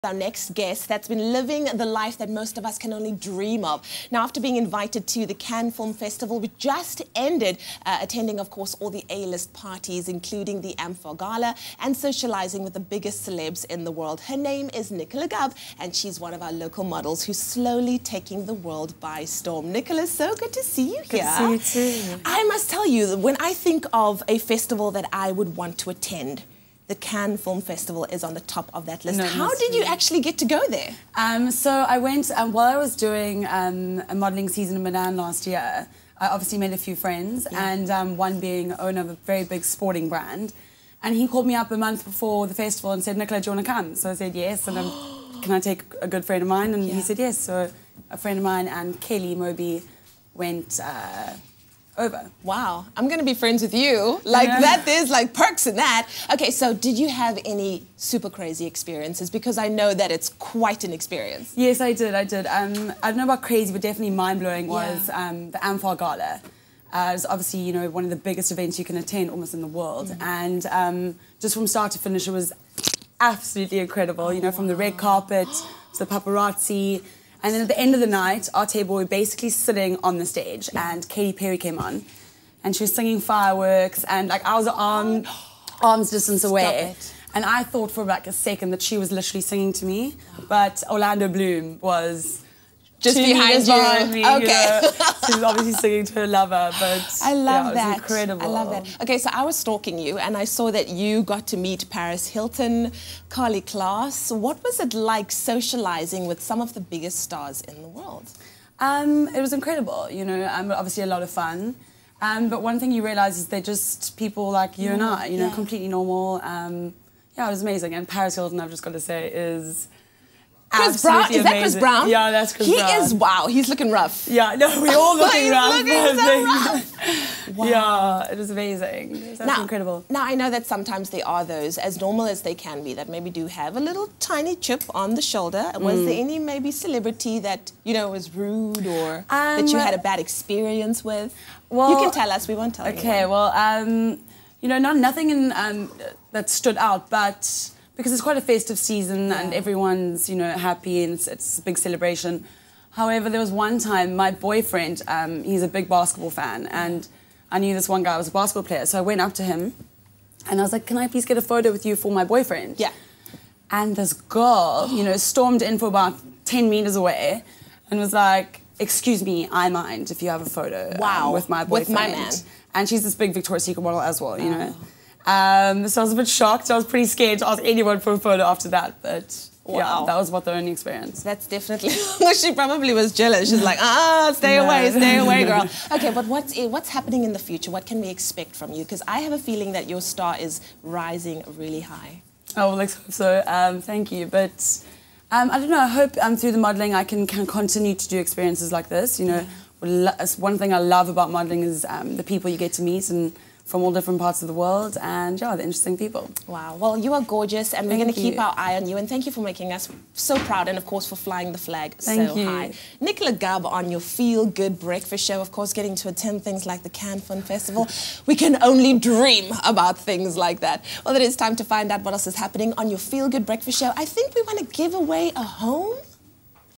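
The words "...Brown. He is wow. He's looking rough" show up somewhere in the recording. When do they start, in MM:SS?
02:02.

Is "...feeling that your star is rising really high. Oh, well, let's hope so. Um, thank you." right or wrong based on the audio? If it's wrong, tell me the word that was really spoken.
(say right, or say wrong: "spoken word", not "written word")
right.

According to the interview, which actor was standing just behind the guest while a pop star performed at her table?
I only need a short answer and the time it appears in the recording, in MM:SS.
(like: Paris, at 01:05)
Orlando Bloom, at 01:30.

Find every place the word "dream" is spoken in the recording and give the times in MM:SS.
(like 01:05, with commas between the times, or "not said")
00:03, 03:38.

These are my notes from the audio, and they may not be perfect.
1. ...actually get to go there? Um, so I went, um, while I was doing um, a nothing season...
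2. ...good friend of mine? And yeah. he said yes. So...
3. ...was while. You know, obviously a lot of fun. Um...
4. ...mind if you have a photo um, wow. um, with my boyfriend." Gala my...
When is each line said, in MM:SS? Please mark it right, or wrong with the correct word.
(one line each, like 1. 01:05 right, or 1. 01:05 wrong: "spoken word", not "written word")
1. 00:29 wrong: "modelling", not "nothing"
2. 00:46 right
3. 01:49 wrong: "incredible", not "while"
4. 02:49 wrong: "With", not "Gala".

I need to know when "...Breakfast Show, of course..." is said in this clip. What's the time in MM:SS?
03:34.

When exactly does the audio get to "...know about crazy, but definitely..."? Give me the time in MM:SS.
01:03.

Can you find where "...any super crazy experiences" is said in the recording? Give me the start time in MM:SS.
00:57.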